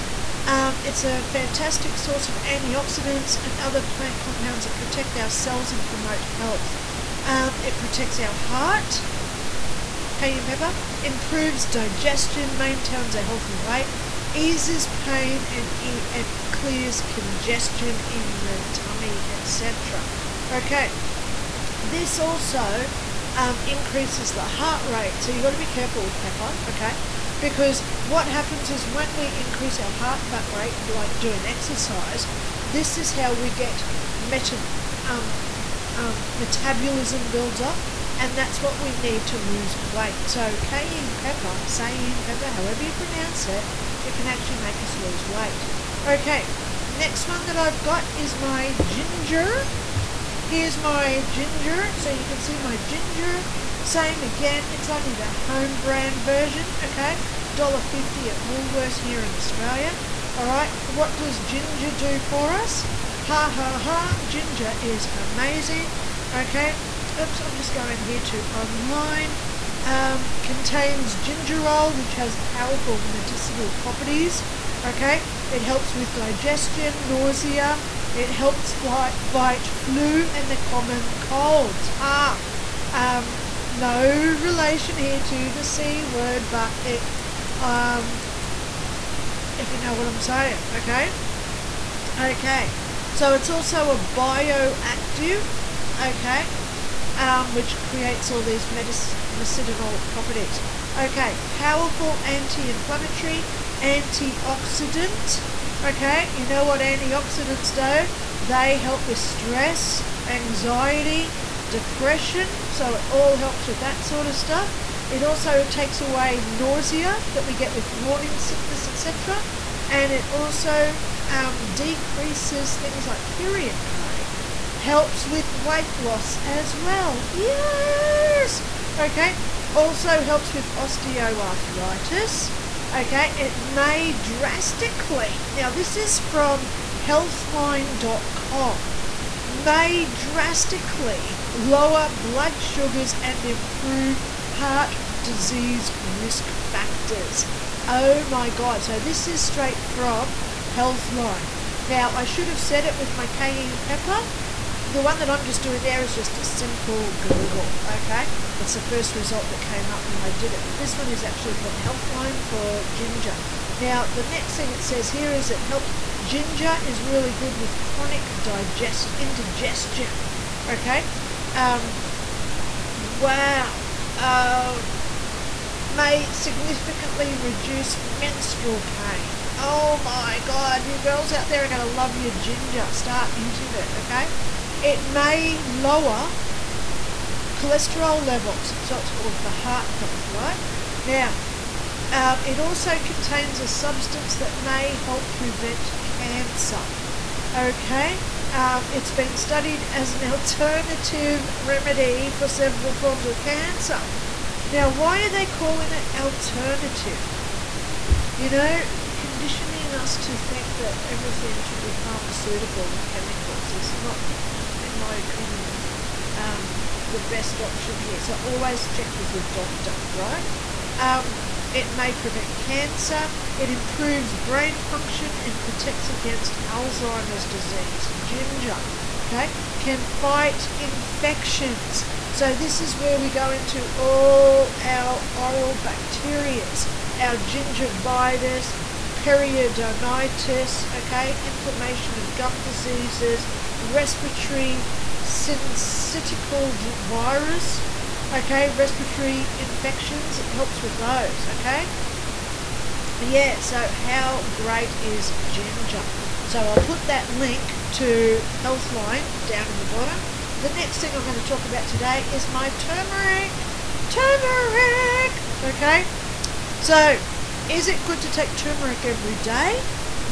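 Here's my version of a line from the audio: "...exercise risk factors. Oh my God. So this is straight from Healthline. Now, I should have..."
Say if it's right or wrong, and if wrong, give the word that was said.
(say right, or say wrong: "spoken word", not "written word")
wrong: "disease", not "exercise".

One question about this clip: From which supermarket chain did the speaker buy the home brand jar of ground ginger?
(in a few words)
Woolworths.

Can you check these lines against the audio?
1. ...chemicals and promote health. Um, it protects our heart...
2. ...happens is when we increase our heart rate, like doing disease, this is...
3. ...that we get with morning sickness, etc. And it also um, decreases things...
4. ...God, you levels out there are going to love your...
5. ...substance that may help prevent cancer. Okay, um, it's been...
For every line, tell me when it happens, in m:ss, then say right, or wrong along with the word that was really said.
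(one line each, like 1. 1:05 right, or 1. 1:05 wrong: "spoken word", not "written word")
1. 0:05 wrong: "cells", not "chemicals"
2. 0:28 wrong: "exercise", not "disease"
3. 1:57 right
4. 3:00 wrong: "girls", not "levels"
5. 3:13 right.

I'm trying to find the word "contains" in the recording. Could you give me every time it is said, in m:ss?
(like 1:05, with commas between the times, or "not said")
1:10, 3:12.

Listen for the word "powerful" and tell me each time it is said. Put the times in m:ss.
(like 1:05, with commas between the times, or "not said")
1:12, 1:41.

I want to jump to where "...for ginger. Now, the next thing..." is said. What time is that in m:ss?
2:42.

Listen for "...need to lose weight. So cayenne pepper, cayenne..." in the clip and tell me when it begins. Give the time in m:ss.
0:38.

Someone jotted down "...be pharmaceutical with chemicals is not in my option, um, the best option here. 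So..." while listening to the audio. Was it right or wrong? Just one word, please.
wrong.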